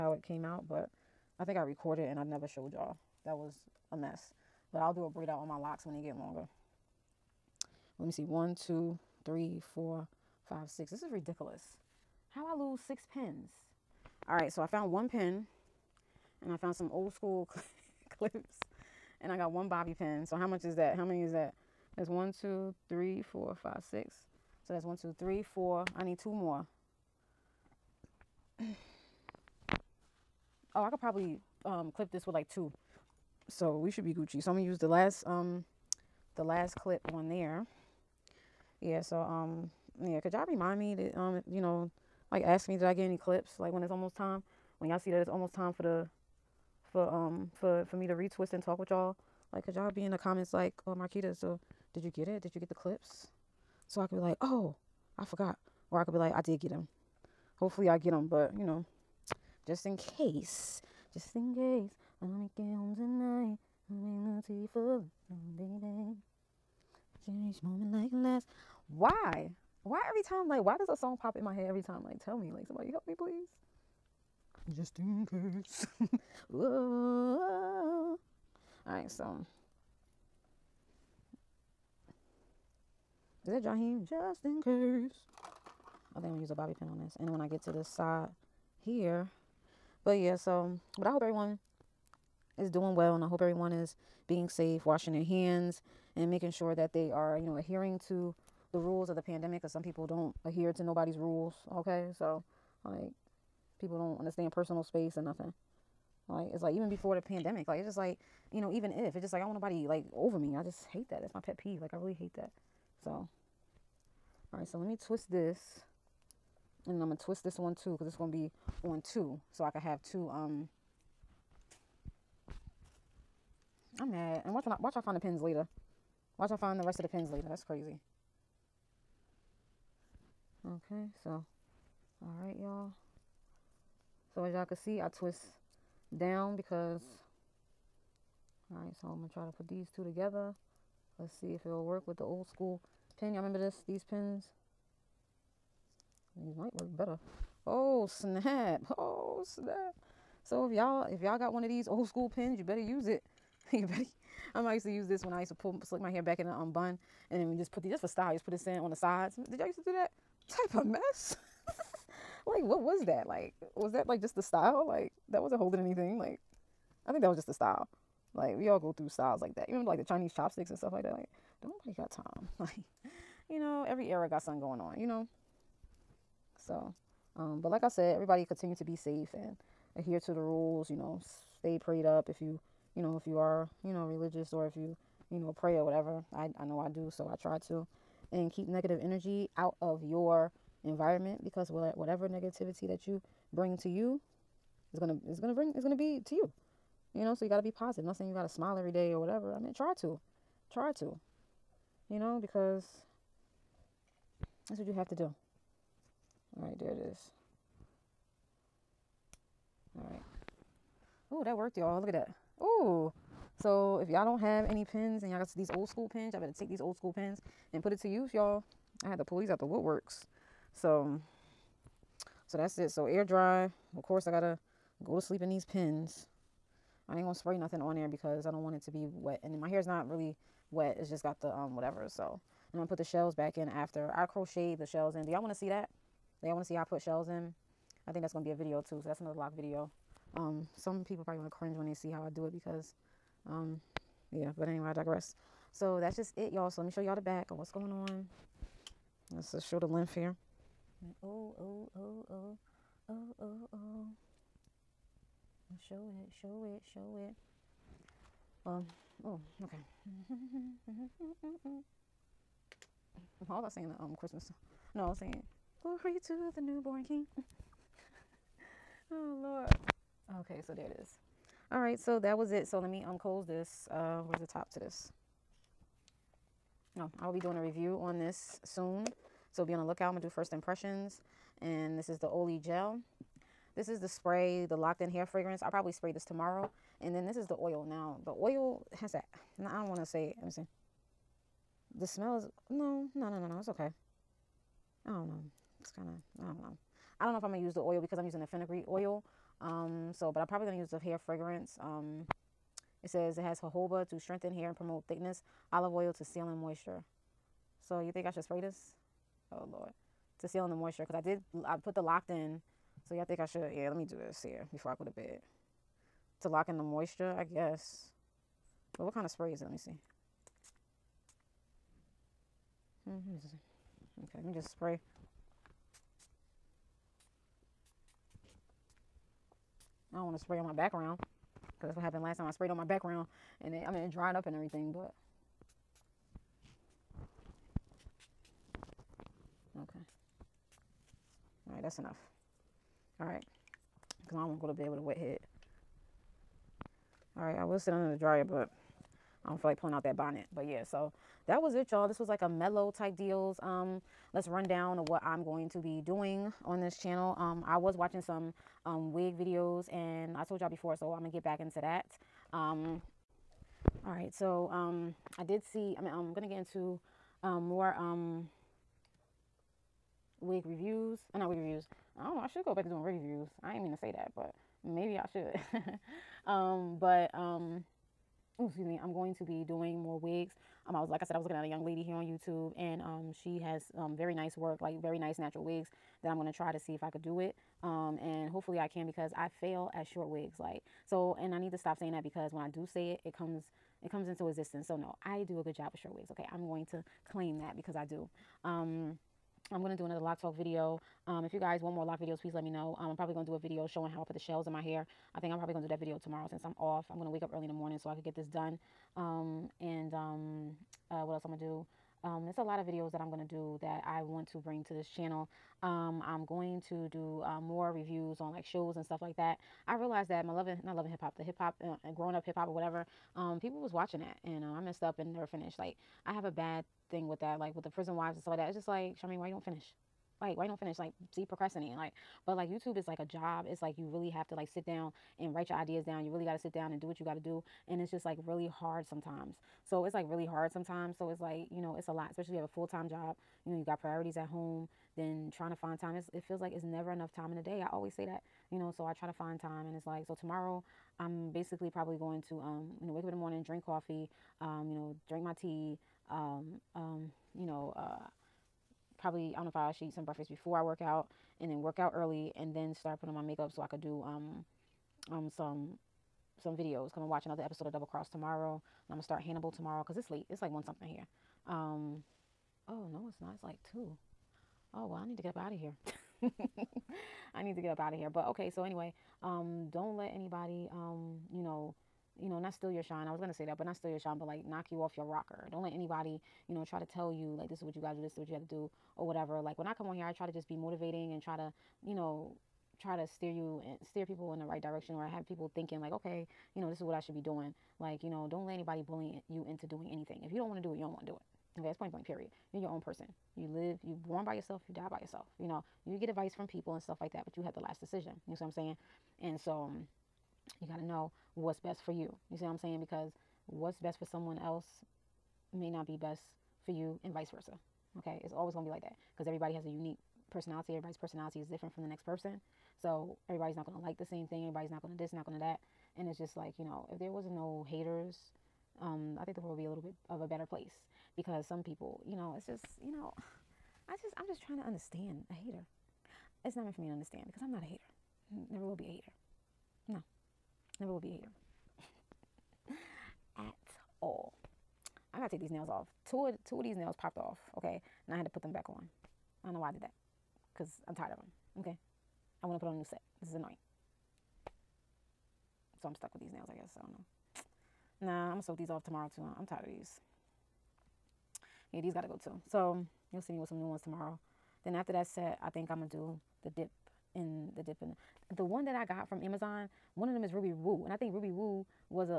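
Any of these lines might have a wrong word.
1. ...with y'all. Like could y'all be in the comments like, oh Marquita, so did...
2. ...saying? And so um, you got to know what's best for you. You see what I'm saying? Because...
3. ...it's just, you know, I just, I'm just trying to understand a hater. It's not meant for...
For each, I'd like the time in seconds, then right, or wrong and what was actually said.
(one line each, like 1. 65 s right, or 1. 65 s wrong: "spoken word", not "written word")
1. 48 s right
2. 508 s right
3. 532 s right.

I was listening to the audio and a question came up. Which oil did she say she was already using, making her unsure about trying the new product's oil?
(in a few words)
fenugreek oil.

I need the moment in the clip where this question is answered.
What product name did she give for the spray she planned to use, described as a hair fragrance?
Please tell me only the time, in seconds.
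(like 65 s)
284 s.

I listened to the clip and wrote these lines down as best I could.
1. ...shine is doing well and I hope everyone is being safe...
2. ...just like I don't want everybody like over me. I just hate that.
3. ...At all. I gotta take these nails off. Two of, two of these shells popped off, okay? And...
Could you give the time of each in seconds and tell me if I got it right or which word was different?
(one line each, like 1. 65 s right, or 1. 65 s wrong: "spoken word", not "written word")
1. 91 s wrong: "everyone", not "shine"
2. 109 s wrong: "nobody", not "everybody"
3. 543 s wrong: "nails", not "shells".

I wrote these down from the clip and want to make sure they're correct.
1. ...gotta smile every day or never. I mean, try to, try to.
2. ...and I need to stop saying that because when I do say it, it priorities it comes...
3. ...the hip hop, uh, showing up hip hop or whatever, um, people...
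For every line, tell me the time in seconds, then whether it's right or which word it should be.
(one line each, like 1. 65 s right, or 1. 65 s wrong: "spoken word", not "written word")
1. 198 s wrong: "whatever", not "never"
2. 391 s wrong: "comes", not "priorities"
3. 421 s wrong: "growing", not "showing".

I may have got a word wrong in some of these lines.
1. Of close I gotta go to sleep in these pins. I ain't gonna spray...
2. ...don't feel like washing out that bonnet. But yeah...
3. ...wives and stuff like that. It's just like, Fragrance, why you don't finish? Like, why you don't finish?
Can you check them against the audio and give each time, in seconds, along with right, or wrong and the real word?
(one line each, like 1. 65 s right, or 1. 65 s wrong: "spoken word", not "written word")
1. 223 s wrong: "course", not "close"
2. 349 s wrong: "pulling", not "washing"
3. 428 s wrong: "Charmaine", not "Fragrance".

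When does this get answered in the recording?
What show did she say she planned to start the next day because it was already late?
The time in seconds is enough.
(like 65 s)
469 s.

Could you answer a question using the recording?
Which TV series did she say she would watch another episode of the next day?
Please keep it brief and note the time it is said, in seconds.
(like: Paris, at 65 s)
Double Cross, at 467 s.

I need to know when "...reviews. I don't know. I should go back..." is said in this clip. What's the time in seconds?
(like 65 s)
371 s.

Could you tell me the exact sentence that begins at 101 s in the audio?
Okay, so like people don't understand personal space or nothing.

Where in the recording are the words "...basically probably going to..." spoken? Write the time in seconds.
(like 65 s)
451 s.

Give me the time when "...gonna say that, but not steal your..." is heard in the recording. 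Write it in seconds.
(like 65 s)
483 s.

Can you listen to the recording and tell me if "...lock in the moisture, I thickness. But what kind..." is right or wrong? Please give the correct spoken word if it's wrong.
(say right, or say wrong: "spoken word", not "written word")
wrong: "guess", not "thickness".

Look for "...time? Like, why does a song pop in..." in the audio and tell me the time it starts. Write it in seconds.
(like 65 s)
70 s.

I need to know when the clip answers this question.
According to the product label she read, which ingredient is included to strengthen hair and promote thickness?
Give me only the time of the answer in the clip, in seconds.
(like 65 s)
303 s.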